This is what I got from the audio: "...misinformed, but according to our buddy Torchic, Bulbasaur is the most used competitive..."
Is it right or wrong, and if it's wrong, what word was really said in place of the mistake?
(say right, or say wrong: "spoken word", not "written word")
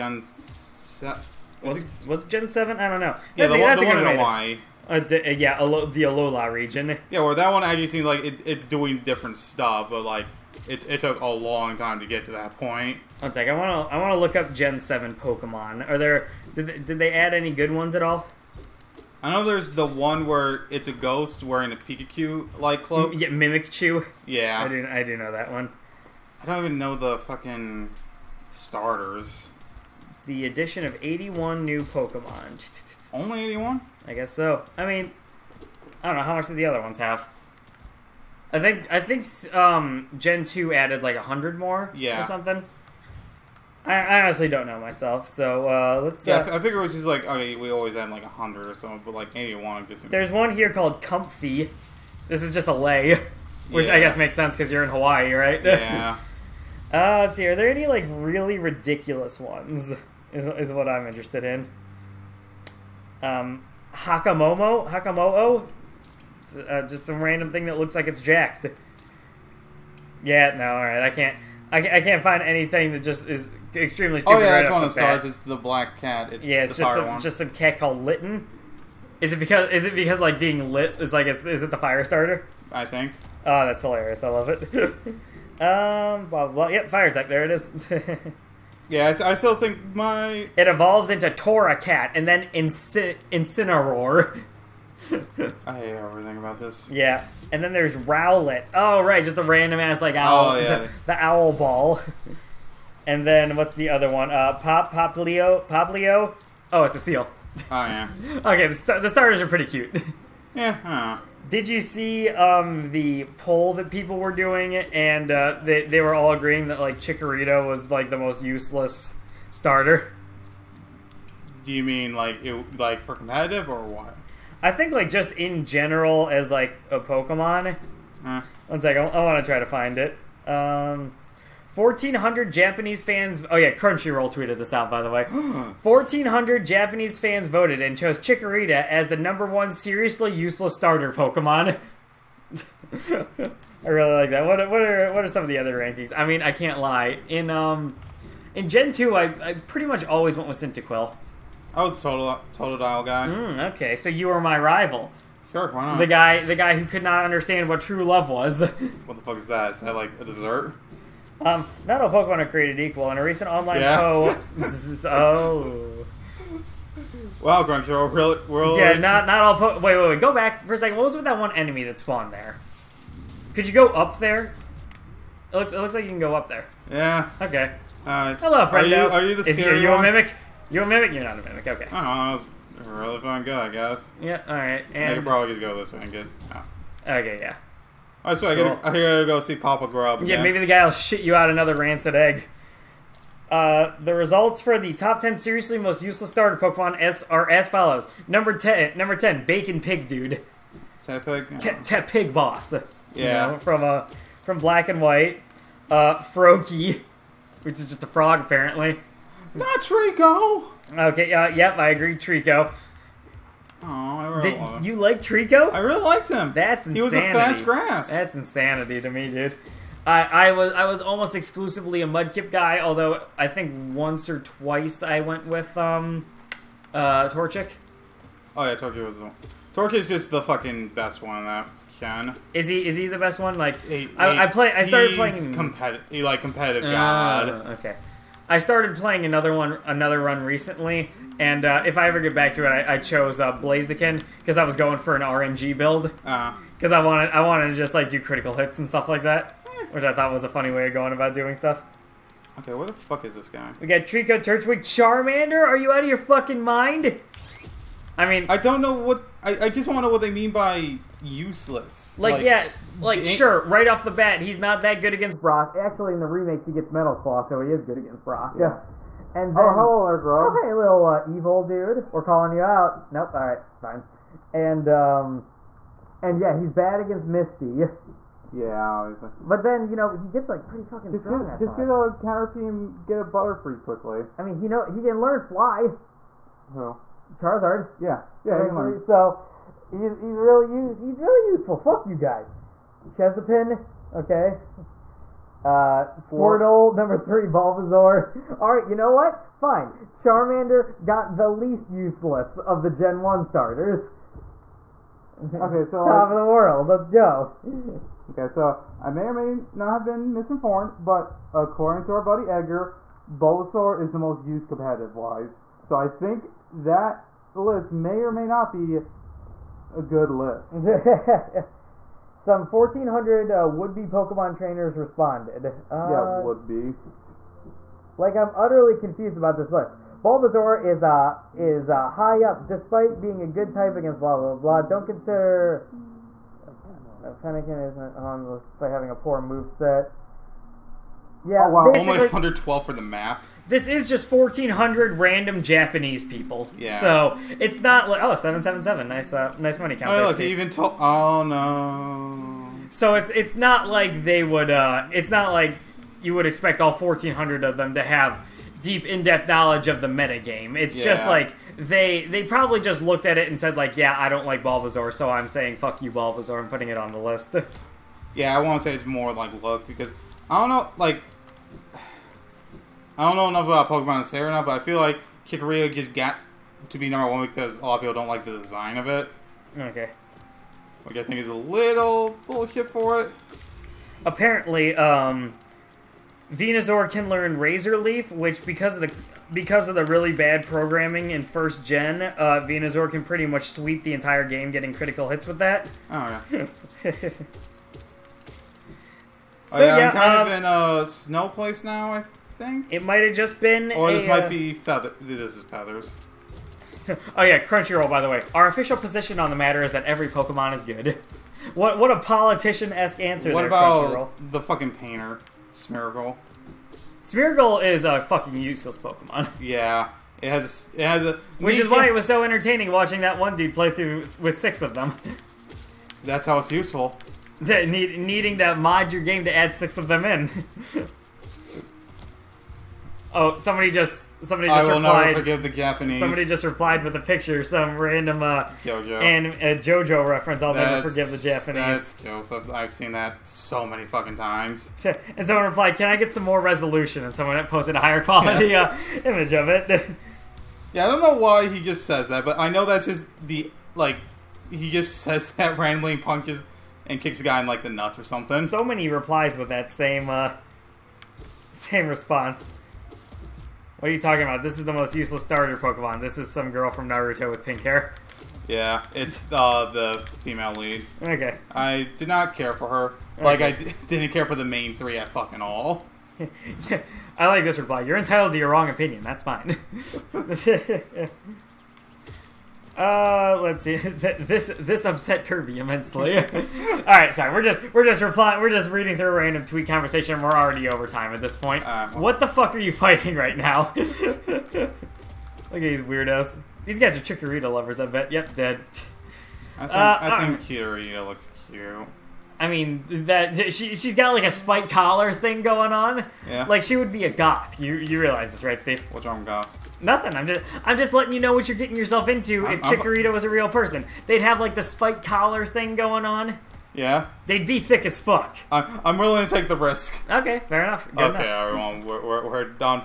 wrong: "Edgar", not "Torchic".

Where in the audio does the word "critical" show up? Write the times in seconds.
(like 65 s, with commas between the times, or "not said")
248 s, 394 s.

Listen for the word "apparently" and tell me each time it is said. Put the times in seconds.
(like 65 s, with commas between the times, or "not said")
208 s, 384 s.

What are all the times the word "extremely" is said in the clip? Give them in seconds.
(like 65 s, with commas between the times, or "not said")
73 s.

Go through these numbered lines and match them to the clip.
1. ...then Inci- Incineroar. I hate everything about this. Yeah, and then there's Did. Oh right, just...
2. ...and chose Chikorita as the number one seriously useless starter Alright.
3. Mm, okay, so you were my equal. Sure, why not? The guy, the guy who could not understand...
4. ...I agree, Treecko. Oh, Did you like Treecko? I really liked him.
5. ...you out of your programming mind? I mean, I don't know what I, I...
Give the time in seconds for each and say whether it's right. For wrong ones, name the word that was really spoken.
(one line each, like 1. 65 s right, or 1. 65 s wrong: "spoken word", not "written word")
1. 92 s wrong: "Rowlet", not "Did"
2. 137 s wrong: "Pokemon", not "Alright"
3. 153 s wrong: "rival", not "equal"
4. 211 s right
5. 255 s wrong: "fucking", not "programming".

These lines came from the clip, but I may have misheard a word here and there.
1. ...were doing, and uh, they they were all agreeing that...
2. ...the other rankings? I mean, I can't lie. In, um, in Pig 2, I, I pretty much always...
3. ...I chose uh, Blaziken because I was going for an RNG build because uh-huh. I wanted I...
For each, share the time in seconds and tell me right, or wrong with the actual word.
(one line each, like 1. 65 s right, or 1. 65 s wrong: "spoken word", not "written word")
1. 114 s right
2. 145 s wrong: "Gen", not "Pig"
3. 242 s right.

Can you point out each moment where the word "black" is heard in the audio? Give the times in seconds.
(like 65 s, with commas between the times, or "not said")
75 s, 204 s.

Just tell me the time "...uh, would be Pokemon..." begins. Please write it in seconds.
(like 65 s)
323 s.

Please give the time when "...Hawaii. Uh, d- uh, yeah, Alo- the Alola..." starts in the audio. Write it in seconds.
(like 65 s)
4 s.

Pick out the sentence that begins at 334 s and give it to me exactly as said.
Don't consider uh, Fennekin isn't on the list despite having a poor move set.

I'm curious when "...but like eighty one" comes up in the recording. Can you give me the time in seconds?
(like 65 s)
49 s.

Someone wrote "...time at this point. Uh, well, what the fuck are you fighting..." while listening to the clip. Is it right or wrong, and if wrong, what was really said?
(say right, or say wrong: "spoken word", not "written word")
right.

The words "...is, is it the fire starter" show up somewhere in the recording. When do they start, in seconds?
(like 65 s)
81 s.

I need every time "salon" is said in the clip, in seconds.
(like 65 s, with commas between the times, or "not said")
not said.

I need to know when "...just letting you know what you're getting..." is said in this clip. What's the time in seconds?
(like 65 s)
510 s.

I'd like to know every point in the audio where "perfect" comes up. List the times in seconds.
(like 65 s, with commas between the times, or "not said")
not said.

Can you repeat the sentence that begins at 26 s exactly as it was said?
I don't even know the fucking starters the addition of 81 new Pokemon.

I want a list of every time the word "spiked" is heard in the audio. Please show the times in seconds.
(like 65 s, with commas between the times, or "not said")
504 s, 514 s.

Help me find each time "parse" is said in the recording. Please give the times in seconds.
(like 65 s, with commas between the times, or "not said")
not said.